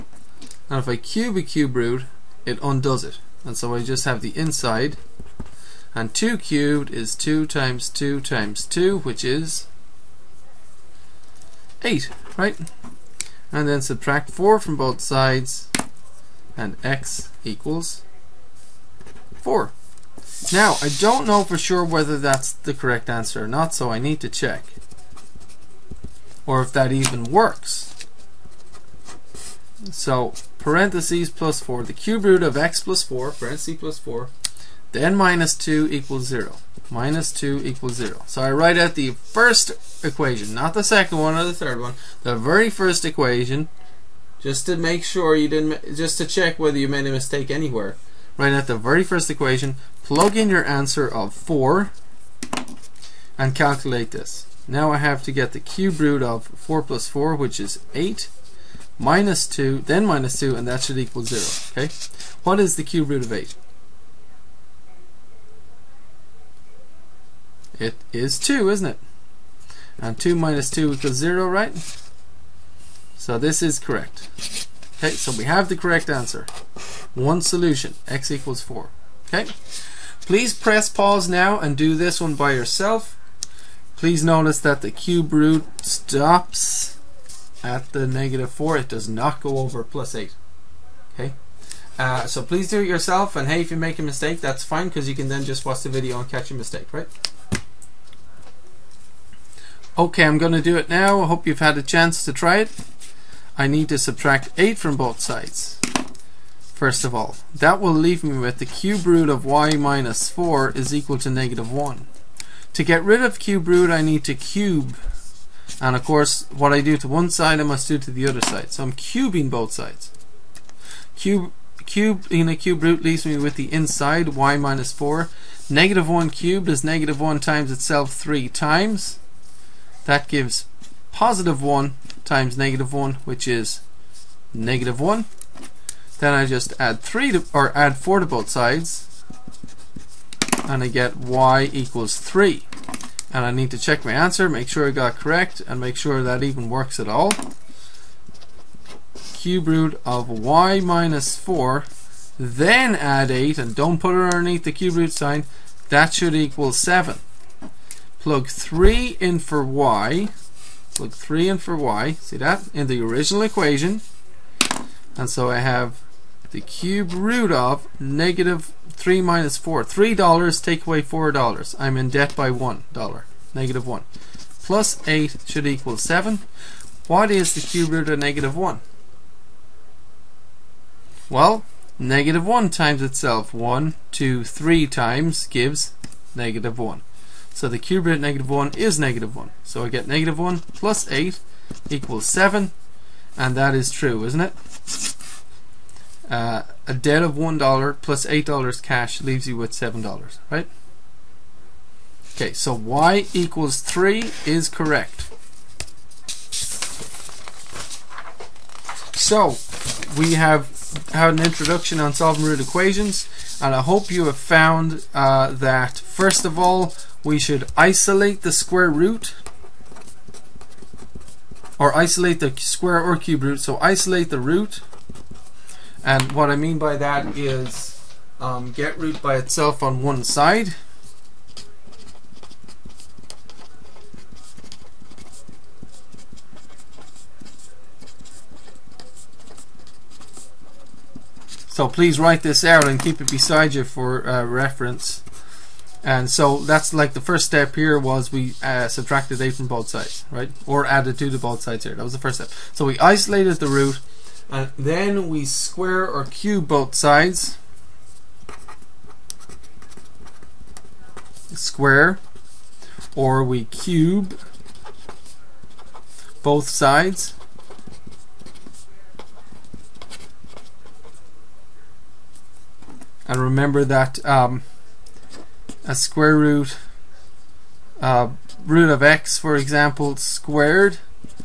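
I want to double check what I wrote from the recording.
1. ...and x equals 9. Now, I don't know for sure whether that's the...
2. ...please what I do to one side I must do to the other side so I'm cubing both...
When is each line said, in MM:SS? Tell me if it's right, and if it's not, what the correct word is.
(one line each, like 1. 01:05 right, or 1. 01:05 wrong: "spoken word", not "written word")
1. 00:16 wrong: "4", not "9"
2. 01:56 wrong: "course", not "please".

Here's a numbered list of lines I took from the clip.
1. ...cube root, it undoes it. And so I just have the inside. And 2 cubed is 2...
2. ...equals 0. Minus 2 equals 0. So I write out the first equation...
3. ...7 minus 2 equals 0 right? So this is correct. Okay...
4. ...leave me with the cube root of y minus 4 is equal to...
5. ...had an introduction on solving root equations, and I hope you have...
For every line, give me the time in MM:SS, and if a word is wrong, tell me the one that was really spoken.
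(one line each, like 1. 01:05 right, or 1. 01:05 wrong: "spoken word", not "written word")
1. 00:01 right
2. 00:35 right
3. 01:10 wrong: "2", not "7"
4. 01:47 right
5. 03:31 right.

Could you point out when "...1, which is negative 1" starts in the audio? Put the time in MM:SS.
02:12.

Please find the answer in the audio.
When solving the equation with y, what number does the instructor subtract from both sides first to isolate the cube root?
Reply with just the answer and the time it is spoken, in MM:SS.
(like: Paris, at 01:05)
8, at 01:43.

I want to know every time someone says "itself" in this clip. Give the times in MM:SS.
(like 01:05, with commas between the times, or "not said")
02:07, 03:03, 03:49.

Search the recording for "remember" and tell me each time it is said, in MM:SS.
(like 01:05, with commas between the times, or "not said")
04:33.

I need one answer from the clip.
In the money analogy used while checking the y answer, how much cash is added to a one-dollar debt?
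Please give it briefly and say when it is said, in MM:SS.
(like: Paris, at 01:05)
$8, at 03:18.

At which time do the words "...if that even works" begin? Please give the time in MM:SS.
00:26.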